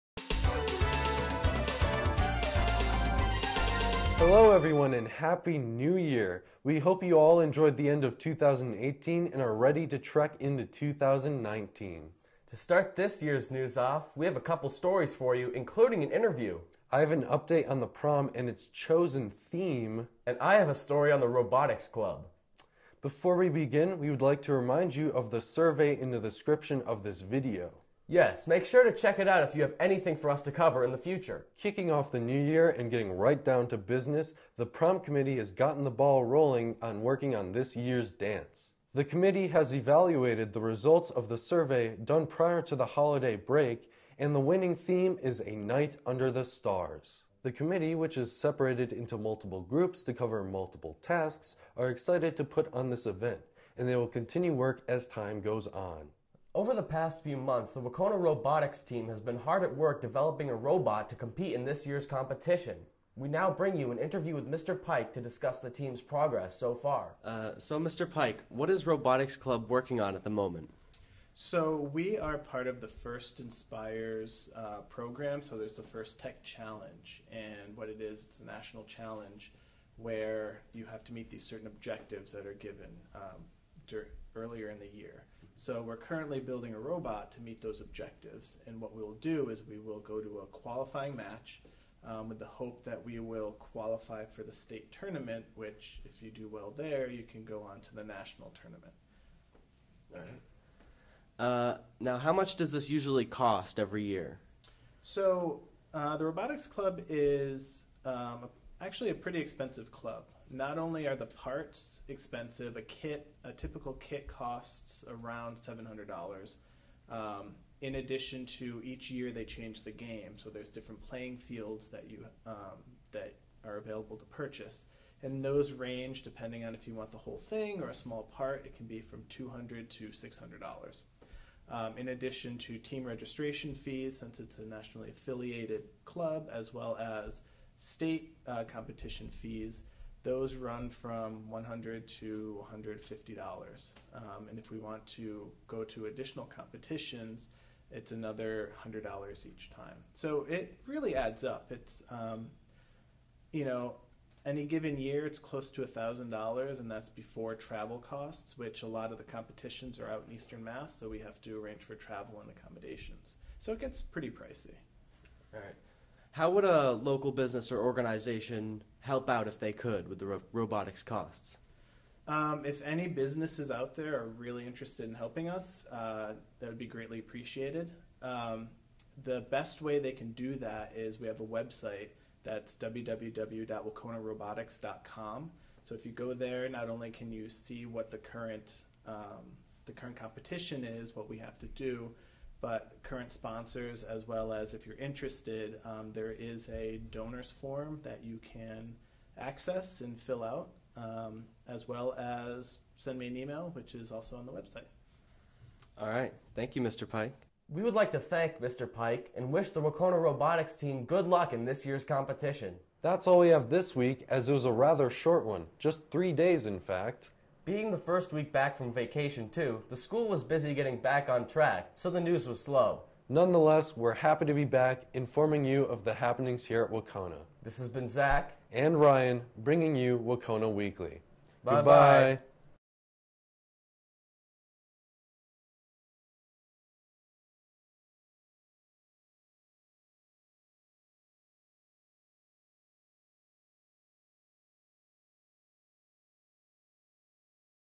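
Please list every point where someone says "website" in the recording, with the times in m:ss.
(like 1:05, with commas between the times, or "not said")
3:01, 3:24.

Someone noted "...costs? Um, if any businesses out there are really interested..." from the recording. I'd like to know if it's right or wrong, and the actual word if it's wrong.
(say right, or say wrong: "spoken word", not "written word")
right.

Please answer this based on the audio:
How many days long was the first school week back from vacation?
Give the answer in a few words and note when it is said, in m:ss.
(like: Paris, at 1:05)
3, at 3:36.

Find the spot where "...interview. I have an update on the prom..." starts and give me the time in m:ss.
0:16.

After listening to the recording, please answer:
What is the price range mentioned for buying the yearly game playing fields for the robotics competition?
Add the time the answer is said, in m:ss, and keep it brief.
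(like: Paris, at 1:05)
$200 to $600, at 2:09.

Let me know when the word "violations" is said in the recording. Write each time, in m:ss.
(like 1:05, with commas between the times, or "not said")
not said.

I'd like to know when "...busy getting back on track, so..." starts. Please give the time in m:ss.
3:40.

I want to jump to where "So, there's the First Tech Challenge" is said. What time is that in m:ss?
1:15.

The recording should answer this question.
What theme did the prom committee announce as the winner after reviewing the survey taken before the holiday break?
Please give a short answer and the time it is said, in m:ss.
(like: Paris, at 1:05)
A Night Under the Stars, at 0:45.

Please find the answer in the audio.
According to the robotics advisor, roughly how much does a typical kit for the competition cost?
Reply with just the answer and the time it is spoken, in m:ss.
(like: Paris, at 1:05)
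$700, at 1:55.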